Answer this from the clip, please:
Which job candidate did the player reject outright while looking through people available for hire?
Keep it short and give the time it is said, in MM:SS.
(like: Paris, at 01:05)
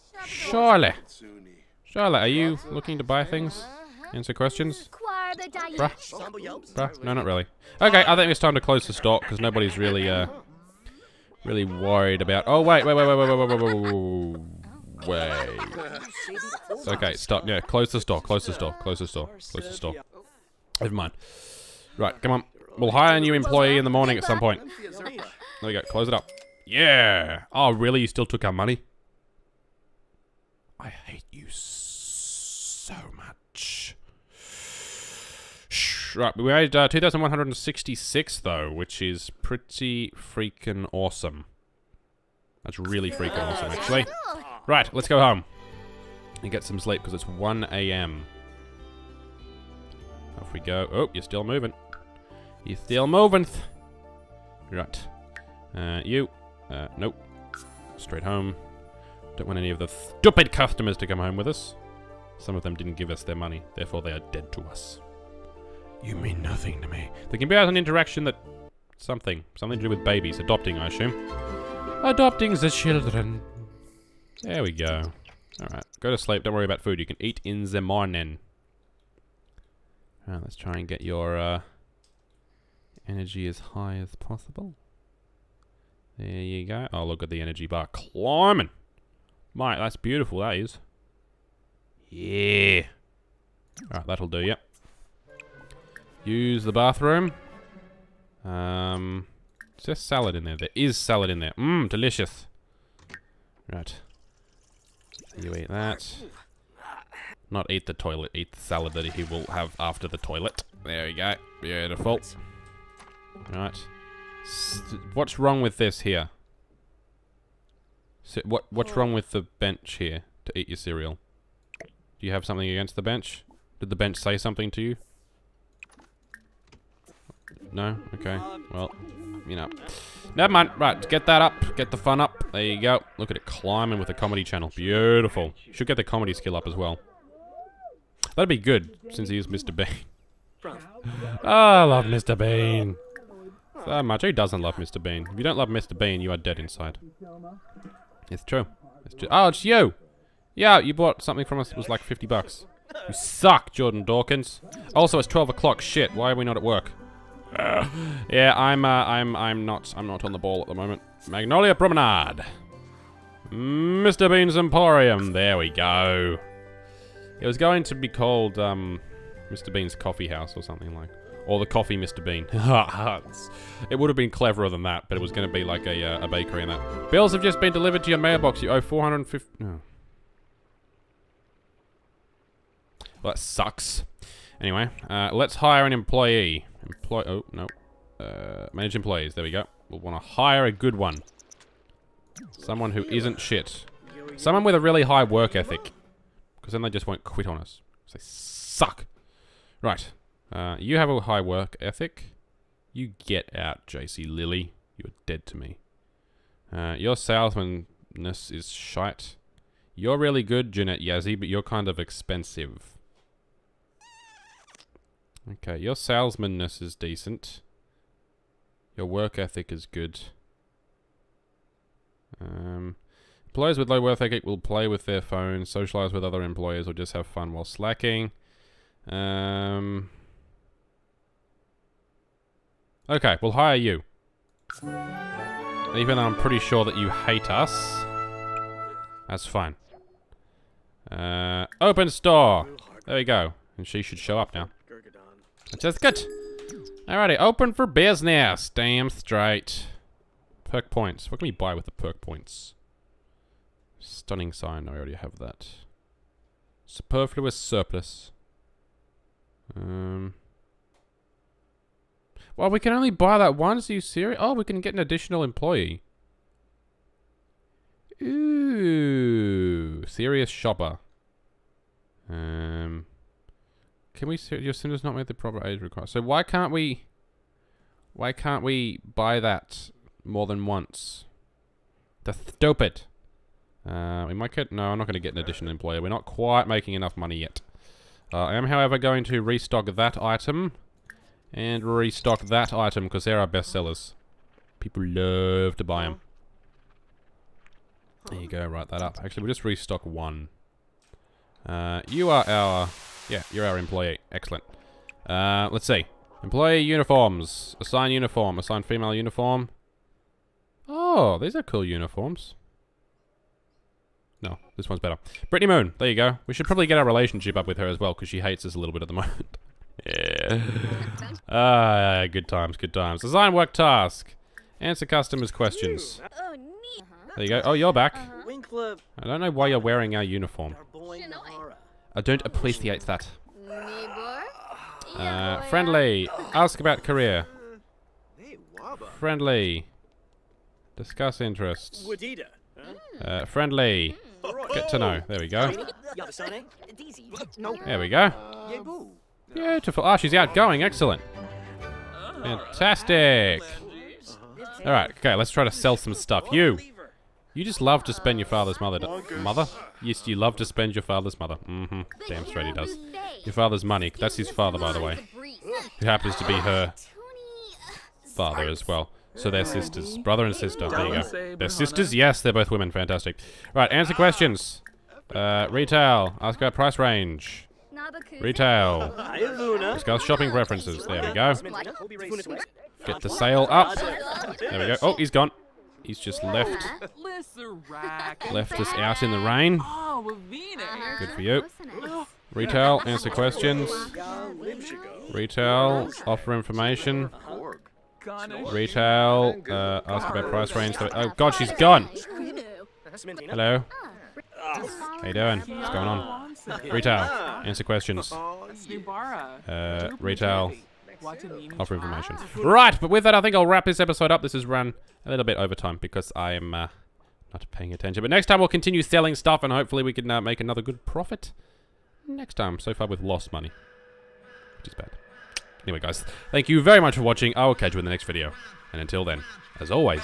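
JC Lilly, at 03:23.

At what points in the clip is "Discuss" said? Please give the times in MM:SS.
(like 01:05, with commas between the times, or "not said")
05:40, 06:19.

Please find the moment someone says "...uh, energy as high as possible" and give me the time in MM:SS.
01:21.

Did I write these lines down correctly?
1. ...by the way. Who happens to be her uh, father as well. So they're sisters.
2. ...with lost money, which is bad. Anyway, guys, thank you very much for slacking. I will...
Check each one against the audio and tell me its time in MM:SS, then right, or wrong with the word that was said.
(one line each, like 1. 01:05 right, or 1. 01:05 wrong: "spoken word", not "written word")
1. 06:04 right
2. 07:03 wrong: "watching", not "slacking".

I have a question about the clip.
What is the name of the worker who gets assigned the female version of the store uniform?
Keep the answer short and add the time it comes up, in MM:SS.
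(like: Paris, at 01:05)
Brittany Moon, at 05:15.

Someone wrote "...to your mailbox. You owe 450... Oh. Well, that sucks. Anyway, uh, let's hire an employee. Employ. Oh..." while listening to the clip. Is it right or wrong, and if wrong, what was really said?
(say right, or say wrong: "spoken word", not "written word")
right.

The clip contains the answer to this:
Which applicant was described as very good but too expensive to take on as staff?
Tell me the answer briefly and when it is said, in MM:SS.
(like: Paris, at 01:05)
Jeanette Yazzie, at 03:30.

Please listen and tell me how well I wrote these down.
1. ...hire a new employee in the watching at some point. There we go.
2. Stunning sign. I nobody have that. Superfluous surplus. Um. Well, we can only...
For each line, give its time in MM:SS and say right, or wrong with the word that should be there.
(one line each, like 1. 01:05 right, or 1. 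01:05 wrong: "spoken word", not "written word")
1. 00:22 wrong: "morning", not "watching"
2. 04:13 wrong: "already", not "nobody".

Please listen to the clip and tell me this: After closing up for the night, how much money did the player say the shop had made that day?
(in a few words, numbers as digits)
2,166.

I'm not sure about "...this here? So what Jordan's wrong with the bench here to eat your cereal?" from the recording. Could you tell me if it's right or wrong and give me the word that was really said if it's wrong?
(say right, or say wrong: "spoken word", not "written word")
wrong: "What", not "Jordan".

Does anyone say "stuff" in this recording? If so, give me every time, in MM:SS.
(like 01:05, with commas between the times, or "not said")
05:56, 06:59.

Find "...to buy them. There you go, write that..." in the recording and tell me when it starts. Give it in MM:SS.
04:55.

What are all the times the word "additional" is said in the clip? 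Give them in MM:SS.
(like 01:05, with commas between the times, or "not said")
04:24, 04:45.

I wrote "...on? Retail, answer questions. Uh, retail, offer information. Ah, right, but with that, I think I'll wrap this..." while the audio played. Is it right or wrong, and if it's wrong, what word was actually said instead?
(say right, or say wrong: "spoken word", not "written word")
right.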